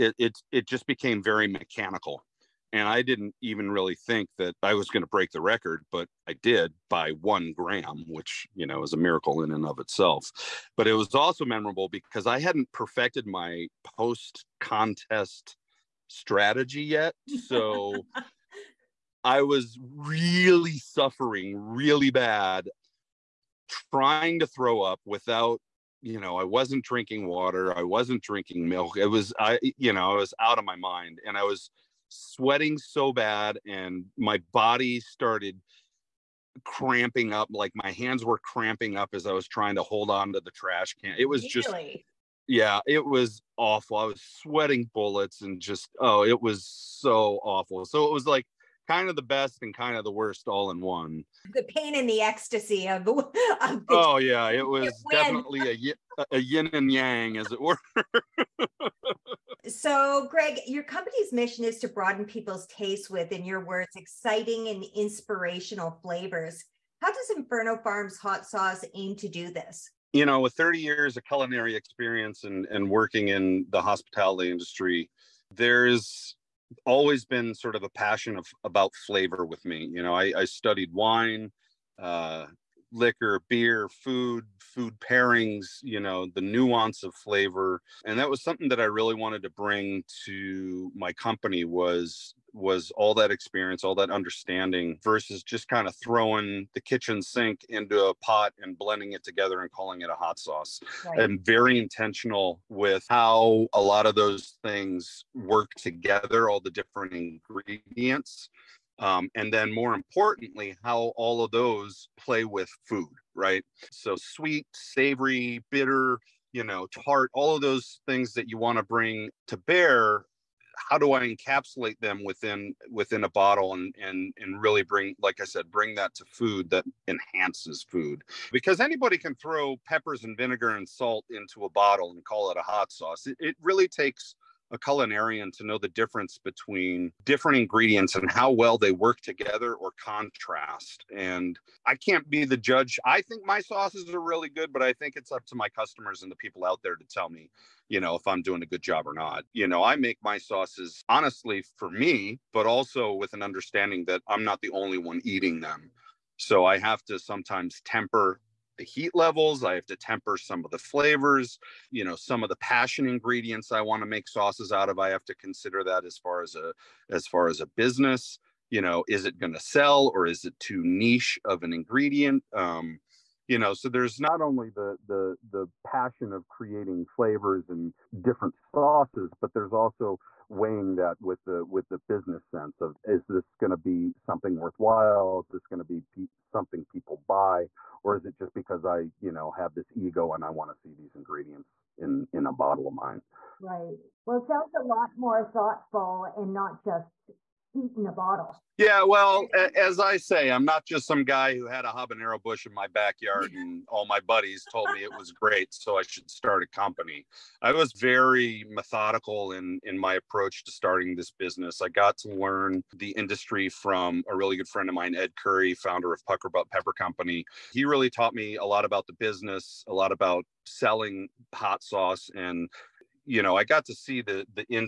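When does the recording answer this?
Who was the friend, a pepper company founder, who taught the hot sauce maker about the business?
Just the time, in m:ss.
3:35.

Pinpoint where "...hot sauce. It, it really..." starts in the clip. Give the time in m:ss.
2:12.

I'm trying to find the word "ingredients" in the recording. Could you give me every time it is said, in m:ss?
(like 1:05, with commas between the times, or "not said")
1:47, 2:17, 2:43, 2:51, 3:11.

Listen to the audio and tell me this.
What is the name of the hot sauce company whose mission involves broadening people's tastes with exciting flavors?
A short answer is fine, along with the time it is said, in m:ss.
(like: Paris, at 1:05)
Inferno Farms, at 1:07.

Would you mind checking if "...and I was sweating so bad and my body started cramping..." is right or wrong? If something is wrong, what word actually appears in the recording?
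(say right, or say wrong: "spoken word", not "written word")
right.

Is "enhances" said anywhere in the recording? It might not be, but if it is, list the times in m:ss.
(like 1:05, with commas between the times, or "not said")
2:07.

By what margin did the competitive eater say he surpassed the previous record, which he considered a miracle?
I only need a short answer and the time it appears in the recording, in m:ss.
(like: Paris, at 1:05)
1 gram, at 0:07.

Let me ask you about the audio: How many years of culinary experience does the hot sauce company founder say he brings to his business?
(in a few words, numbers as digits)
30.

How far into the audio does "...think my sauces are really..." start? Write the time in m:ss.
2:23.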